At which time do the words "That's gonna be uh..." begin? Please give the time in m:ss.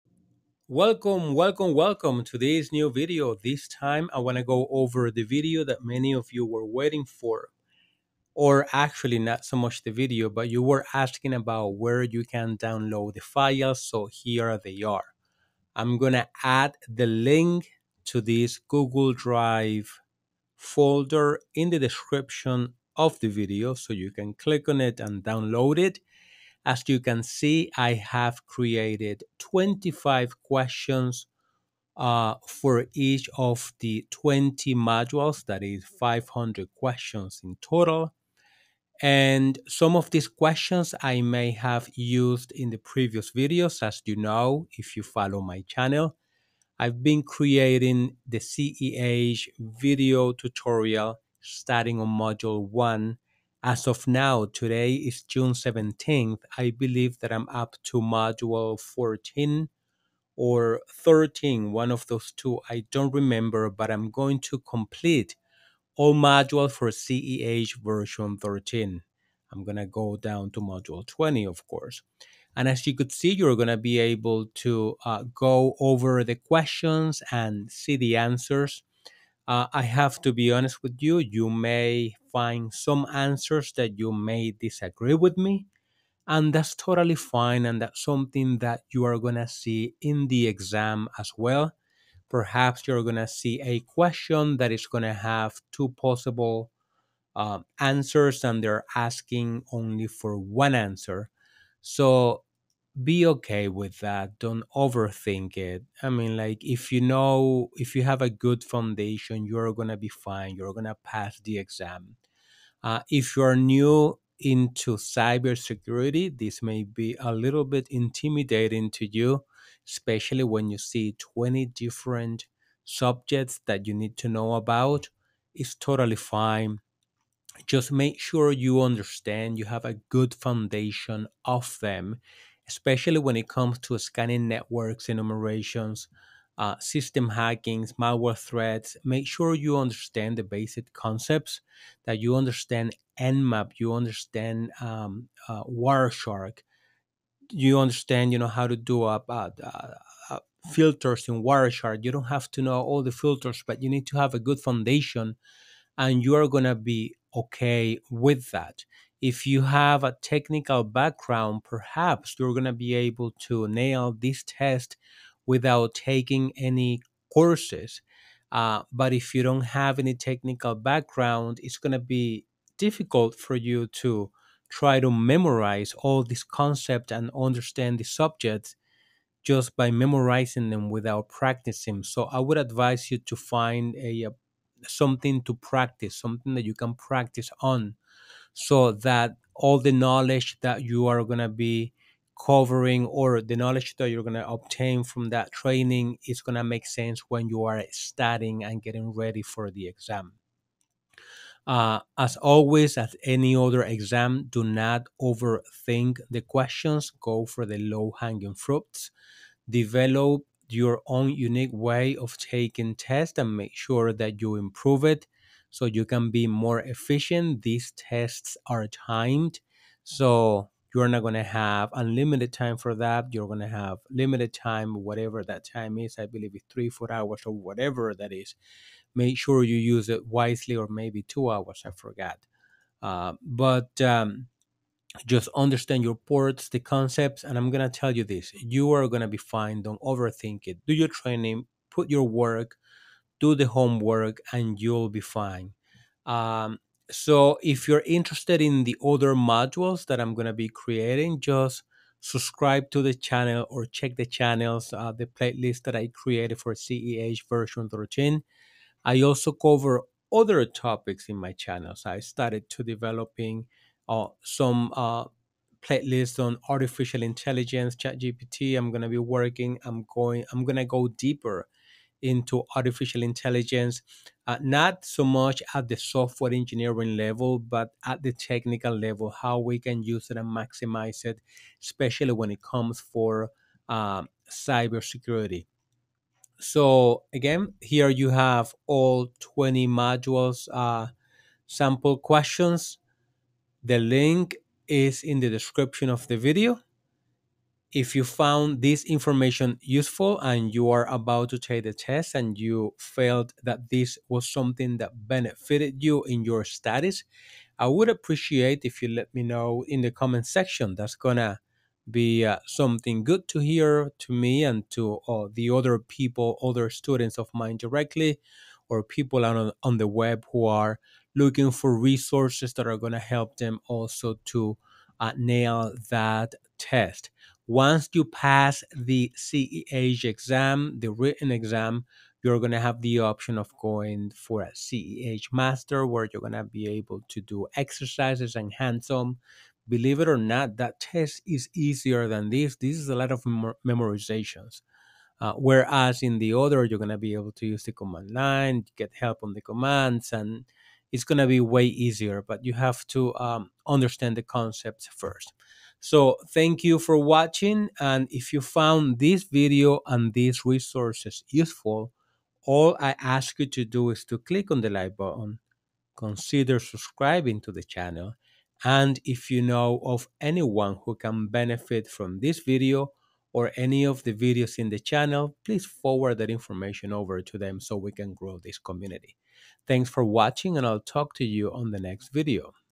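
5:10.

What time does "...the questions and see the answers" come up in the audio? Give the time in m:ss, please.
1:16.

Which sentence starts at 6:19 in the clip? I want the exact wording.
Thanks for watching and I'll talk to you on the next video.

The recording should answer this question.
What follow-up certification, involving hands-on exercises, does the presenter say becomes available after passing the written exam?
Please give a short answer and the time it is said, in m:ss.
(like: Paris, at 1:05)
CEH master, at 5:34.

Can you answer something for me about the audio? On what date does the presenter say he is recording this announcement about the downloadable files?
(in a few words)
June 17th.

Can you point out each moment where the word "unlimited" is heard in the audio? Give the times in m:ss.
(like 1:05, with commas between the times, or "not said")
3:41.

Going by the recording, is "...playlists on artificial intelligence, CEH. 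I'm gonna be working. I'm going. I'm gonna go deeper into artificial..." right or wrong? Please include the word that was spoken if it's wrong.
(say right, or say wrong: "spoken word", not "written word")
wrong: "ChatGPT", not "CEH".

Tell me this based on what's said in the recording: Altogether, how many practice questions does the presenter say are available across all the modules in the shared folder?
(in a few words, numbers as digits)
500.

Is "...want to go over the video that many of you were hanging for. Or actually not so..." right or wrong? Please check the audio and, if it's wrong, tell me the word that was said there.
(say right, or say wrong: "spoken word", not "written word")
wrong: "waiting", not "hanging".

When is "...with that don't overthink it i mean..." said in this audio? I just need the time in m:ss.
1:43.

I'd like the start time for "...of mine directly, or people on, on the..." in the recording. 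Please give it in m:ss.
5:17.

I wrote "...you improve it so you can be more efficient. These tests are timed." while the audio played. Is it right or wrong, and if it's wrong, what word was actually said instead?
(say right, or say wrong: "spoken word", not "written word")
right.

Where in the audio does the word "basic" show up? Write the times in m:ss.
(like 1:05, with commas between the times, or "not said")
2:20.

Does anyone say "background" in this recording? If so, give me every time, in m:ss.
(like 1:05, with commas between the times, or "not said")
2:40, 2:50.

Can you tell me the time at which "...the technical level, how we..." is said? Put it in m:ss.
4:38.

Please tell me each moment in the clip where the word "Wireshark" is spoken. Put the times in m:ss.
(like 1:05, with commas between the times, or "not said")
2:25, 2:31.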